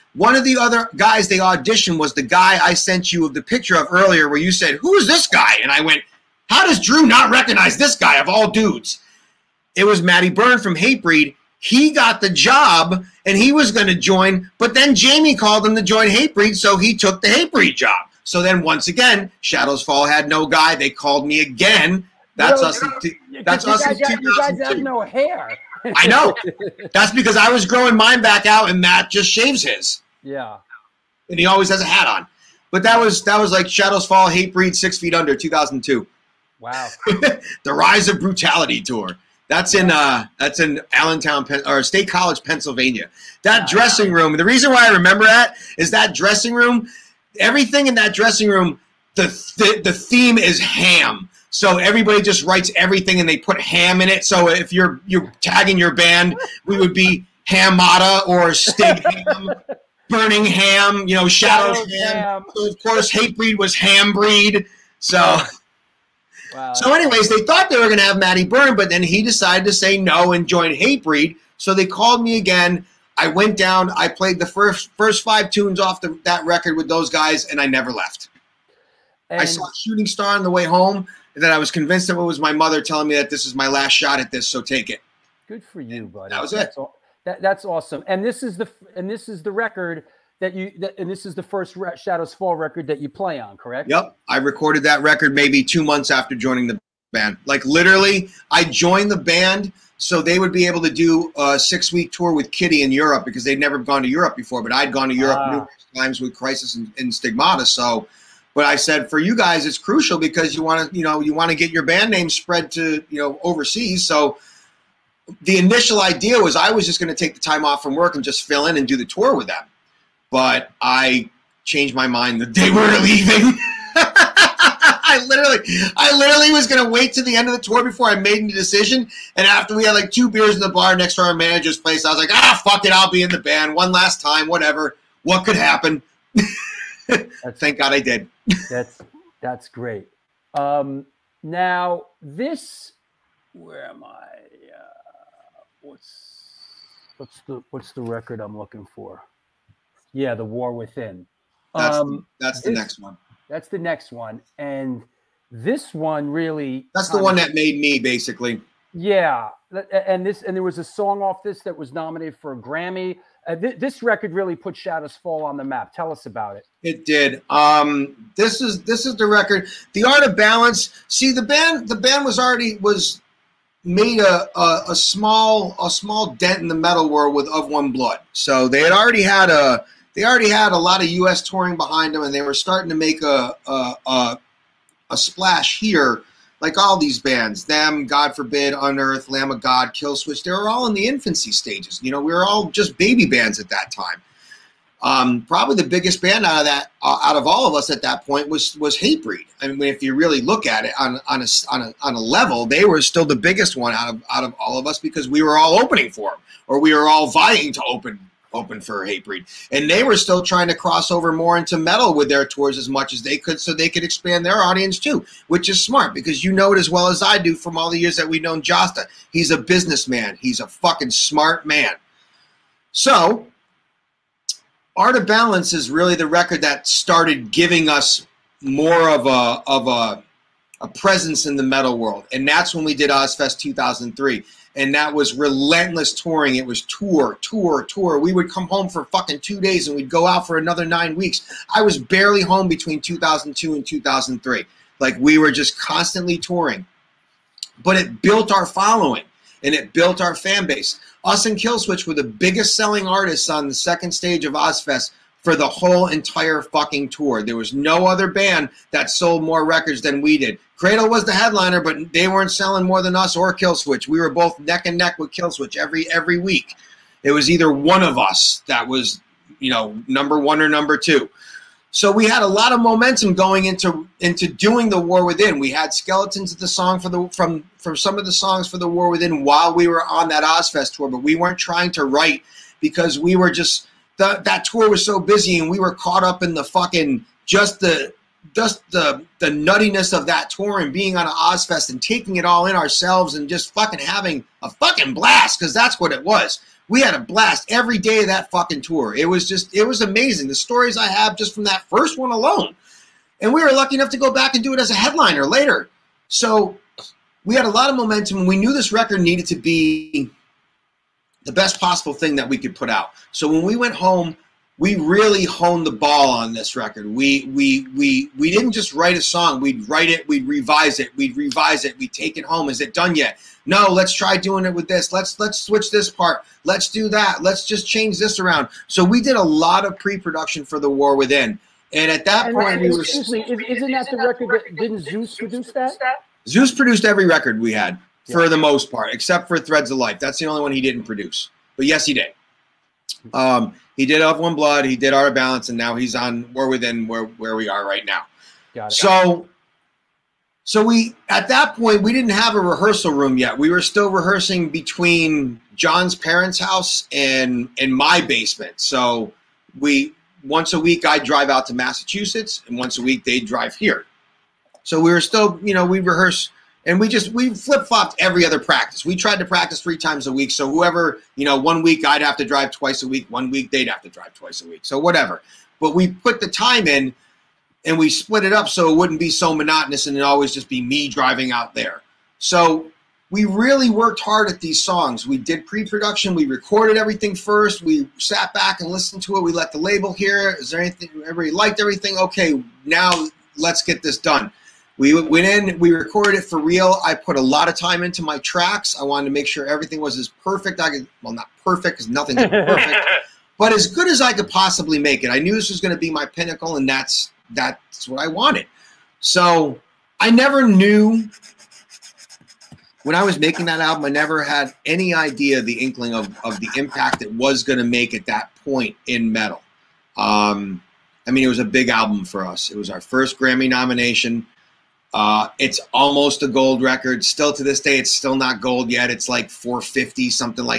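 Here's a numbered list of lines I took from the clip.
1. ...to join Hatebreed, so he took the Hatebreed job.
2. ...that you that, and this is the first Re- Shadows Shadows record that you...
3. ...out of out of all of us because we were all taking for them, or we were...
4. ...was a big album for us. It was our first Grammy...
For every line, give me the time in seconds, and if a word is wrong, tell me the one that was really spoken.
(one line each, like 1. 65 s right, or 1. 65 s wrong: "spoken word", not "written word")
1. 15 s right
2. 90 s wrong: "Fall", not "Shadows"
3. 203 s wrong: "opening", not "taking"
4. 421 s right.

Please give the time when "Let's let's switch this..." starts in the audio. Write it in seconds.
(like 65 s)
325 s.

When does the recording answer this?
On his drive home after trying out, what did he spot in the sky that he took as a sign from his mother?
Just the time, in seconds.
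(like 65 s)
79 s.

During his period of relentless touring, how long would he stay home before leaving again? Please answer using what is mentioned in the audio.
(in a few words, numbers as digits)
2 days.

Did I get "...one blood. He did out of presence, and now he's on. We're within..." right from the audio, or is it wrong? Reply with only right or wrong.
wrong.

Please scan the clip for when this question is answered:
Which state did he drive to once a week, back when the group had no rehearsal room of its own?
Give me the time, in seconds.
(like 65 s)
361 s.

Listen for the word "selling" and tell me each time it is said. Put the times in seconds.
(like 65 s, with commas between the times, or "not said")
252 s, 262 s.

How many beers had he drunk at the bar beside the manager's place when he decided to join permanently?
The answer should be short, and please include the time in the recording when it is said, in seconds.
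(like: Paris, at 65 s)
2, at 130 s.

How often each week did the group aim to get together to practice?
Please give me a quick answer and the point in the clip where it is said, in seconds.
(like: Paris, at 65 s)
3 times a week, at 369 s.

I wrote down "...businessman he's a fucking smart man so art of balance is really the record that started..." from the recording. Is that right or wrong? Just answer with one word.
right.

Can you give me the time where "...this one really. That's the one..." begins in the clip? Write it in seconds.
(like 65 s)
155 s.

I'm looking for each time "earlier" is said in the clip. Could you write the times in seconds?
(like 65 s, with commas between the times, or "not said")
3 s.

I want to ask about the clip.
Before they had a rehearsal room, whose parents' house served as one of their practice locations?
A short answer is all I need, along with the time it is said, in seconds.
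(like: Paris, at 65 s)
John's, at 355 s.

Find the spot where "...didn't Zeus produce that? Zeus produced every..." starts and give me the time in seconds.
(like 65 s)
334 s.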